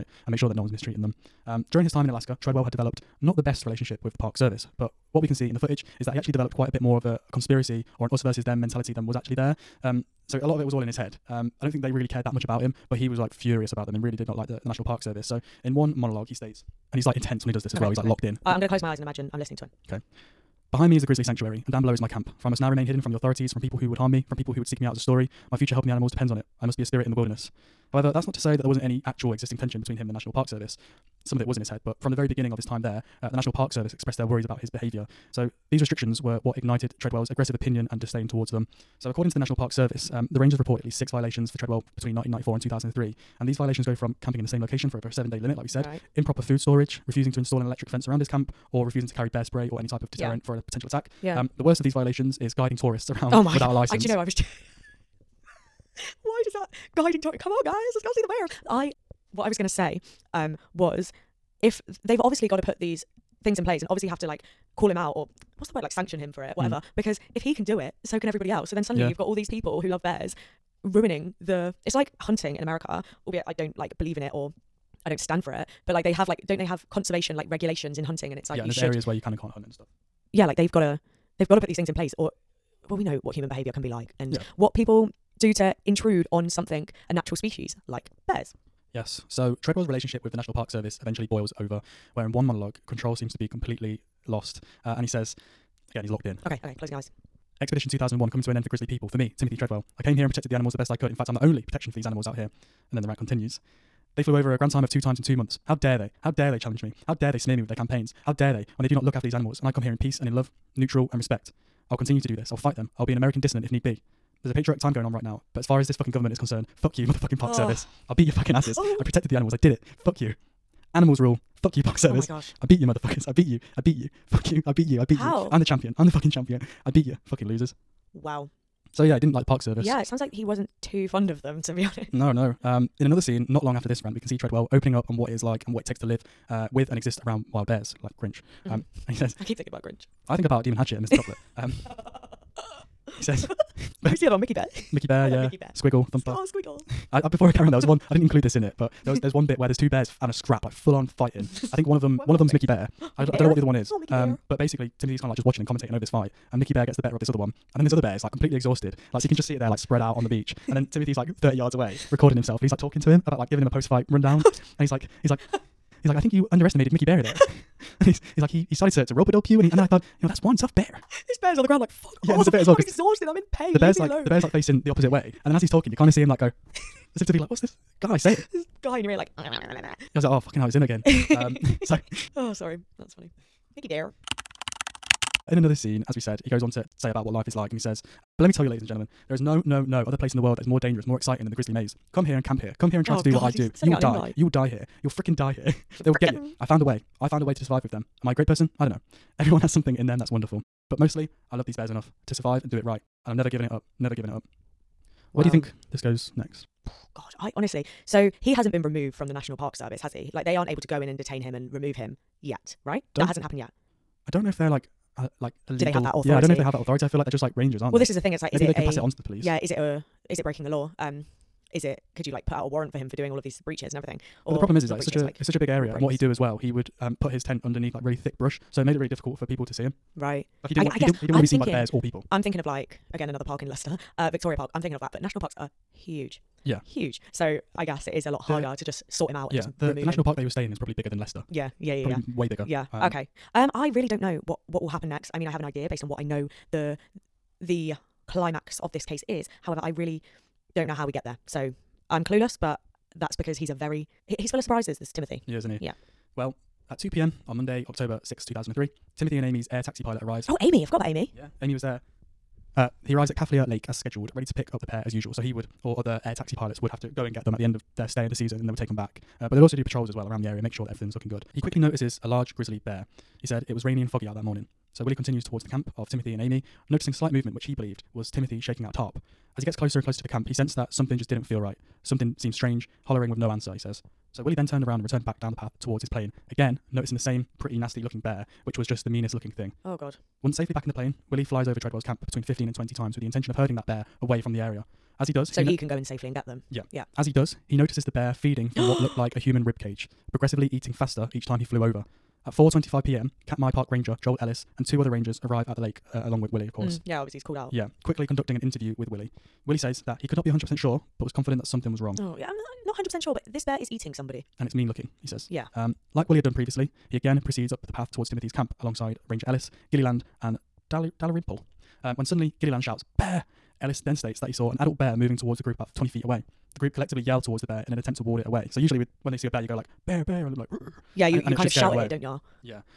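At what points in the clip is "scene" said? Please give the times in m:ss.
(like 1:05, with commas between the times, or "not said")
2:13, 3:05.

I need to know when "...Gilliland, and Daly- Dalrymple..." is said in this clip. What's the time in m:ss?
5:19.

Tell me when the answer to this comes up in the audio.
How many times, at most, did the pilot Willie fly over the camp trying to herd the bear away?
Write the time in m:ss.
4:52.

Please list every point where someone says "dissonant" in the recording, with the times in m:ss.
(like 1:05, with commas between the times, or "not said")
1:53.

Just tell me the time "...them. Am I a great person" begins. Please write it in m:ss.
3:17.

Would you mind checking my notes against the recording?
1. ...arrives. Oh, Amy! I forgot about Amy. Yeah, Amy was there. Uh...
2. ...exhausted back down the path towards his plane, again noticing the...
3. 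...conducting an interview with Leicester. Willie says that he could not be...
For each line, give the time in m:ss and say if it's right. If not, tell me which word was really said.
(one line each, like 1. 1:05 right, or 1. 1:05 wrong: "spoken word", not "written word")
1. 4:20 right
2. 4:45 wrong: "returned", not "exhausted"
3. 5:08 wrong: "Willie", not "Leicester".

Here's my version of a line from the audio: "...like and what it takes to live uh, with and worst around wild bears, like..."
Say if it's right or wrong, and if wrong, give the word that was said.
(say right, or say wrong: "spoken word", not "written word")
wrong: "exist", not "worst".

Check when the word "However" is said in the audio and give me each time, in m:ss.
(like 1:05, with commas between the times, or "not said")
0:27, 4:09.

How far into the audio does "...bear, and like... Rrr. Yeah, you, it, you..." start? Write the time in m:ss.
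5:30.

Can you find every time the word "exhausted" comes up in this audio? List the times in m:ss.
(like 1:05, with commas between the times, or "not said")
2:38, 2:52.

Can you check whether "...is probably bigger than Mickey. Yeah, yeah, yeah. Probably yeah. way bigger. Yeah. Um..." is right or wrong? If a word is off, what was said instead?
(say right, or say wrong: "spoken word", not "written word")
wrong: "Leicester", not "Mickey".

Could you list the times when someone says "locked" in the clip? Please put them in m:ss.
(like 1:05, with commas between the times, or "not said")
0:18, 1:36.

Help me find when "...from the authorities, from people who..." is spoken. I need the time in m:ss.
0:23.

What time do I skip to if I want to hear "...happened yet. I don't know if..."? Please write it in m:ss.
3:33.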